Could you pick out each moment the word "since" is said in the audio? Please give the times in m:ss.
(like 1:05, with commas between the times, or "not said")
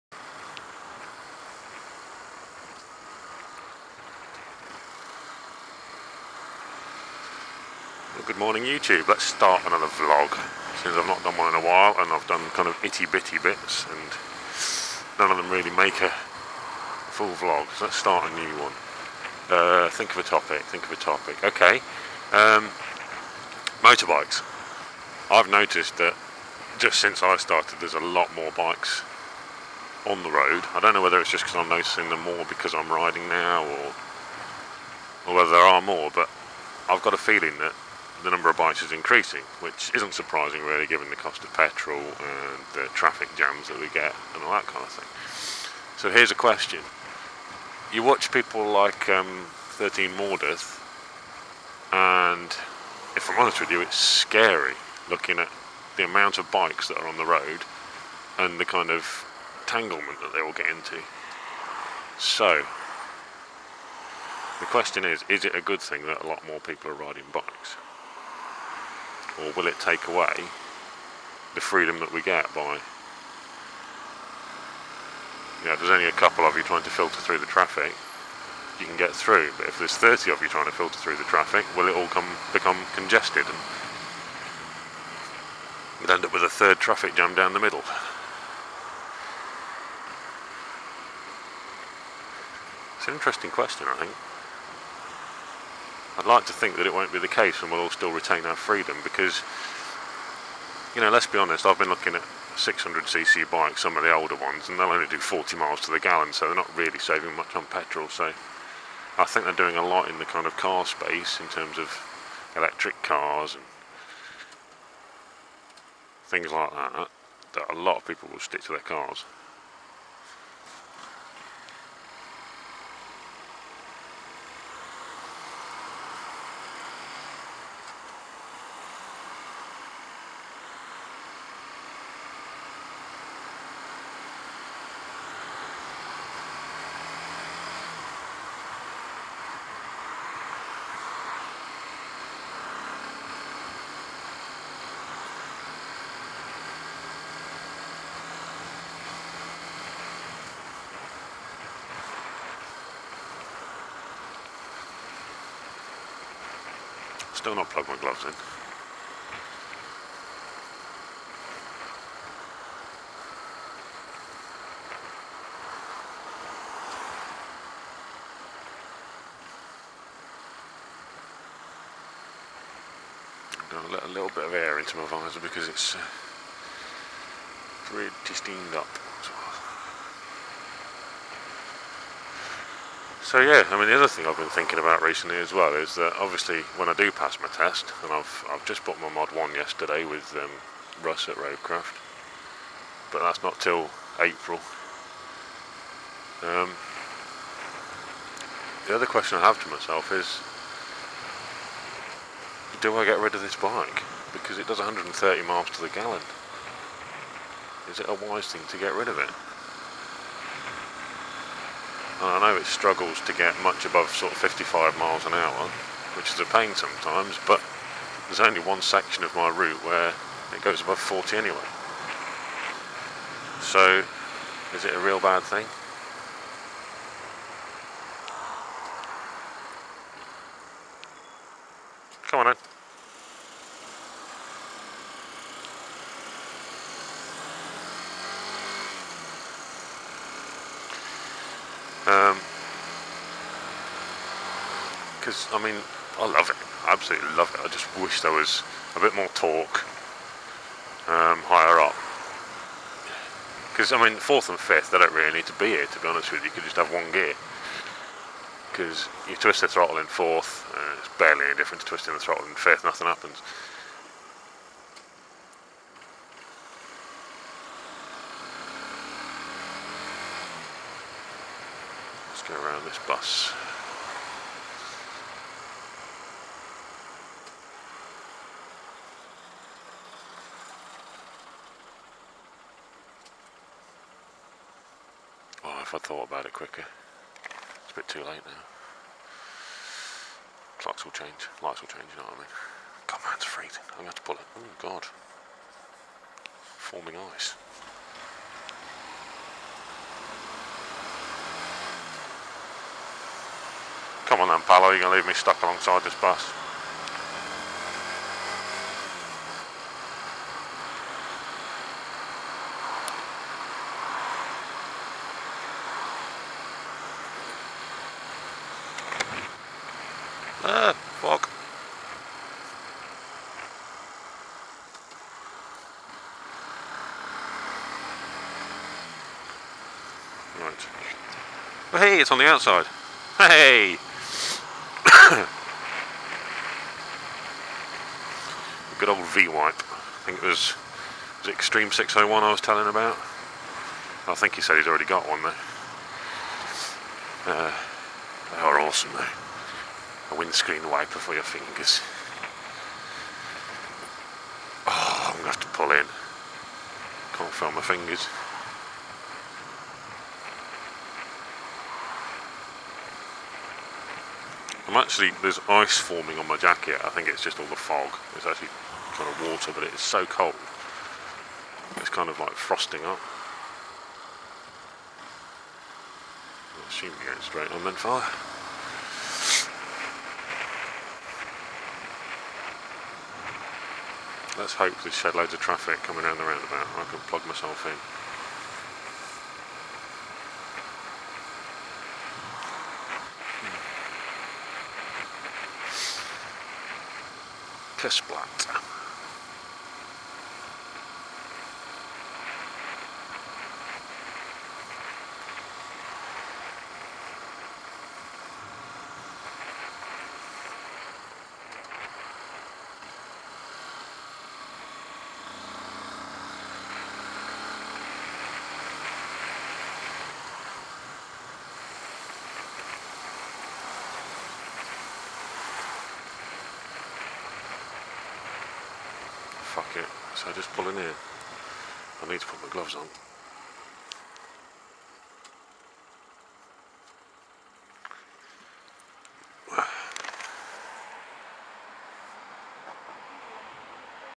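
0:10, 0:27.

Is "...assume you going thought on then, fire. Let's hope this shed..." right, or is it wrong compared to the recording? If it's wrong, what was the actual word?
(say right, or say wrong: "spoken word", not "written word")
wrong: "straight", not "thought".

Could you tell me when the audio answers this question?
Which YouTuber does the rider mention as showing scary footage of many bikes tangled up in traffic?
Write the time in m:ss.
0:49.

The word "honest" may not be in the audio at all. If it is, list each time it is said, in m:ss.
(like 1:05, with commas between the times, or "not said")
0:53, 1:41, 4:16.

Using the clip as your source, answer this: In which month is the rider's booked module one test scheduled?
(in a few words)
April.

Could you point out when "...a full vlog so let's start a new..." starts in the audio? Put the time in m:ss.
0:16.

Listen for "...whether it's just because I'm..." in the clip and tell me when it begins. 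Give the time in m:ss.
0:31.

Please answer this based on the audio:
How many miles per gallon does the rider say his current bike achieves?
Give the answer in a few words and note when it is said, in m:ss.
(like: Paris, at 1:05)
130, at 3:24.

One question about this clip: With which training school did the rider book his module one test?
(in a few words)
Roadcraft.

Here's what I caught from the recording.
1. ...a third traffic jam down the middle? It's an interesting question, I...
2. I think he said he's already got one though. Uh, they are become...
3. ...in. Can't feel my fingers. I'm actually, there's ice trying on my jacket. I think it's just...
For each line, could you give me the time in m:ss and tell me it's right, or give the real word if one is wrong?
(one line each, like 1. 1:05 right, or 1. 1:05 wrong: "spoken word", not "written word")
1. 1:26 right
2. 5:44 wrong: "awesome", not "become"
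3. 5:55 wrong: "forming", not "trying".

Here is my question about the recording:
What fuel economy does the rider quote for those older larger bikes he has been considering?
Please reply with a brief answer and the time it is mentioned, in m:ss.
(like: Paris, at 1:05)
40 miles to the gallon, at 1:45.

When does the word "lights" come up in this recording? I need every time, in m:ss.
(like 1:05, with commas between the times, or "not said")
4:51.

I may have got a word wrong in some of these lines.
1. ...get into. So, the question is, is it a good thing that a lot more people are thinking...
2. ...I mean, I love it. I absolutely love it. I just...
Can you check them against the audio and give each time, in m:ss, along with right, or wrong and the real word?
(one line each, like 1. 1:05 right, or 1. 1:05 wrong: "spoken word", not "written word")
1. 1:00 wrong: "riding", not "thinking"
2. 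4:05 right.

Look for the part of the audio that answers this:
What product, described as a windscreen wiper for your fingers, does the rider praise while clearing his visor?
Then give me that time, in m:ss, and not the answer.
5:39.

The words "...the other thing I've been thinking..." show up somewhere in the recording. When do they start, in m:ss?
3:03.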